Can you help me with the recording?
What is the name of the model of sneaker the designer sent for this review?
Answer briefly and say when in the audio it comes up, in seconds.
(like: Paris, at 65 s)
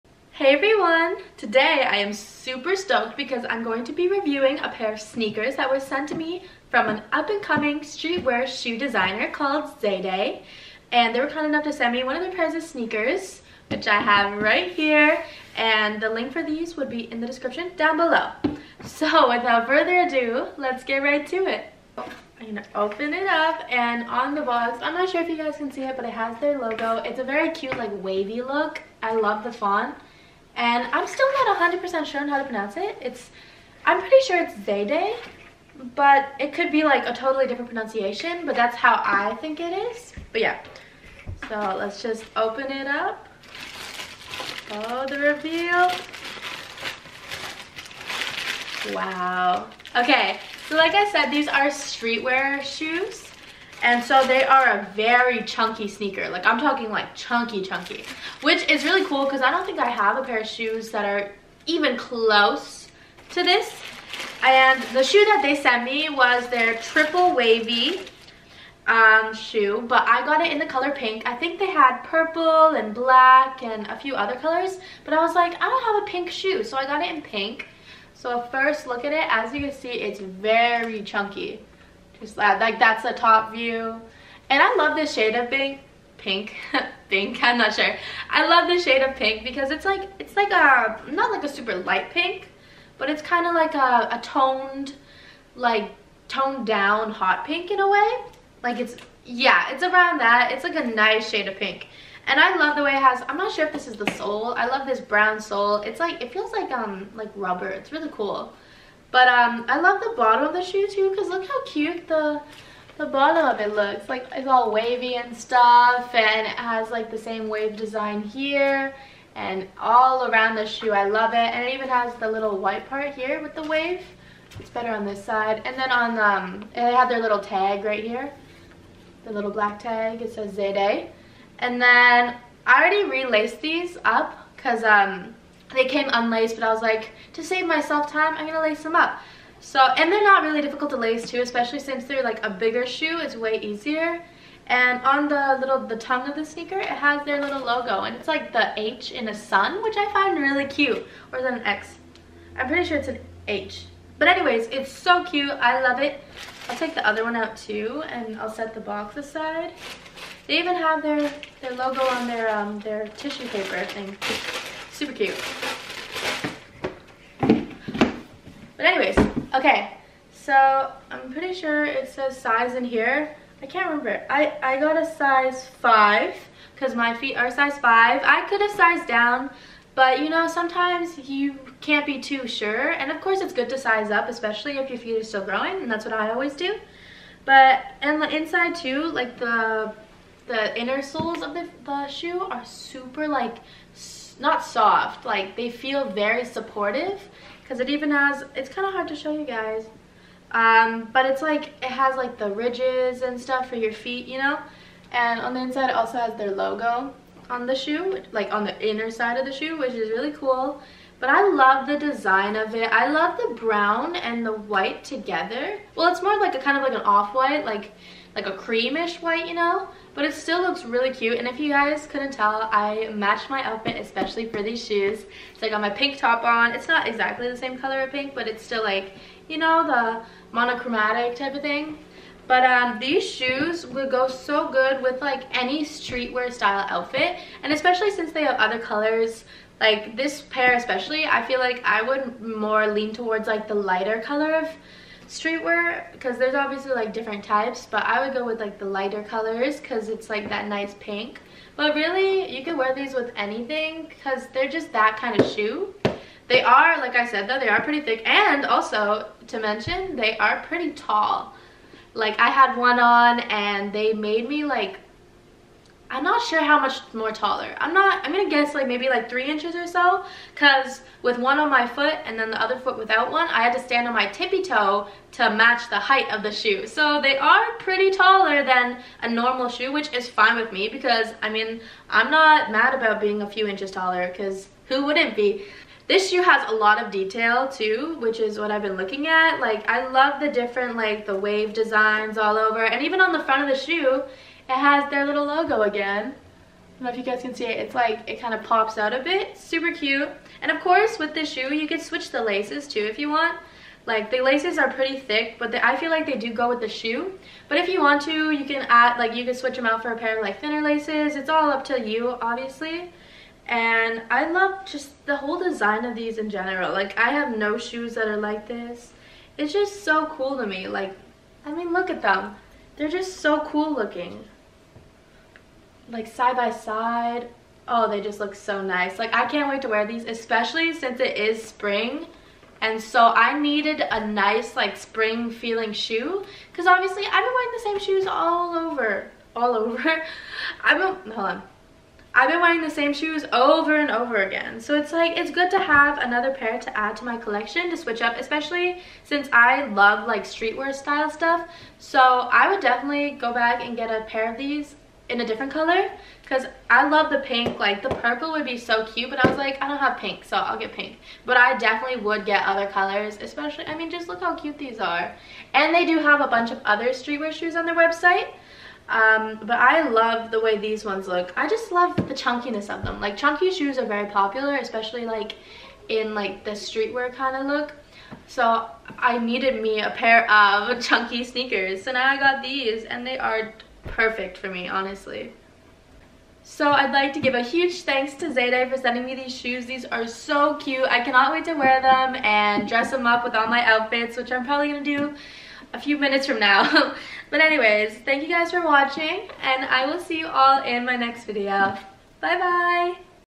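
triple wavy, at 66 s.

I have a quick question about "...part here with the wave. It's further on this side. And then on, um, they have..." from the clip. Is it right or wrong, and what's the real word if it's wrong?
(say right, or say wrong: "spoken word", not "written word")
wrong: "better", not "further".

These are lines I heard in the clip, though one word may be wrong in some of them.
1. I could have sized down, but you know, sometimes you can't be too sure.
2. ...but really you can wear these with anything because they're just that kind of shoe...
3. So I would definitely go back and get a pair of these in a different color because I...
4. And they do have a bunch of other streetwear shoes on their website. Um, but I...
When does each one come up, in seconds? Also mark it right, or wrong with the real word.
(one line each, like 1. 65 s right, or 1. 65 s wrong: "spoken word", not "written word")
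1. 178 s right
2. 251 s right
3. 351 s right
4. 365 s right.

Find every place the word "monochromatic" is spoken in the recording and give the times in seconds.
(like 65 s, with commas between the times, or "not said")
230 s.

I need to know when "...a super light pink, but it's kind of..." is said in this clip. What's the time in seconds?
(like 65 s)
91 s.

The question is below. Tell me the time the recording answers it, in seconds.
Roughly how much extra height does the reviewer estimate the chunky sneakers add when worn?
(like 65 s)
269 s.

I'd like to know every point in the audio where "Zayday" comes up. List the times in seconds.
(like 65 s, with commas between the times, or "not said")
9 s, 34 s, 130 s, 388 s.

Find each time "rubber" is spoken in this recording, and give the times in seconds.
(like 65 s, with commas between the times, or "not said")
107 s.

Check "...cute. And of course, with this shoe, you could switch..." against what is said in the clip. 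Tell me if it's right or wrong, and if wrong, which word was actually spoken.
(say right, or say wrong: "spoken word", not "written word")
right.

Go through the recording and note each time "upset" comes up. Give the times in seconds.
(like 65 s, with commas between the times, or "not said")
not said.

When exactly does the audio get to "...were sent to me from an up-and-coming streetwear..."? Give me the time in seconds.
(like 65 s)
5 s.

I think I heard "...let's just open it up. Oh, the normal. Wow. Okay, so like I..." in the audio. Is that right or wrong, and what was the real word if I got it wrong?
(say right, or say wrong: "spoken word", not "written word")
wrong: "reveal", not "normal".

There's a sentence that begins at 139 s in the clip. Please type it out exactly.
So, and they're not really difficult to lace too, especially since they're like a bigger shoe, it's way easier.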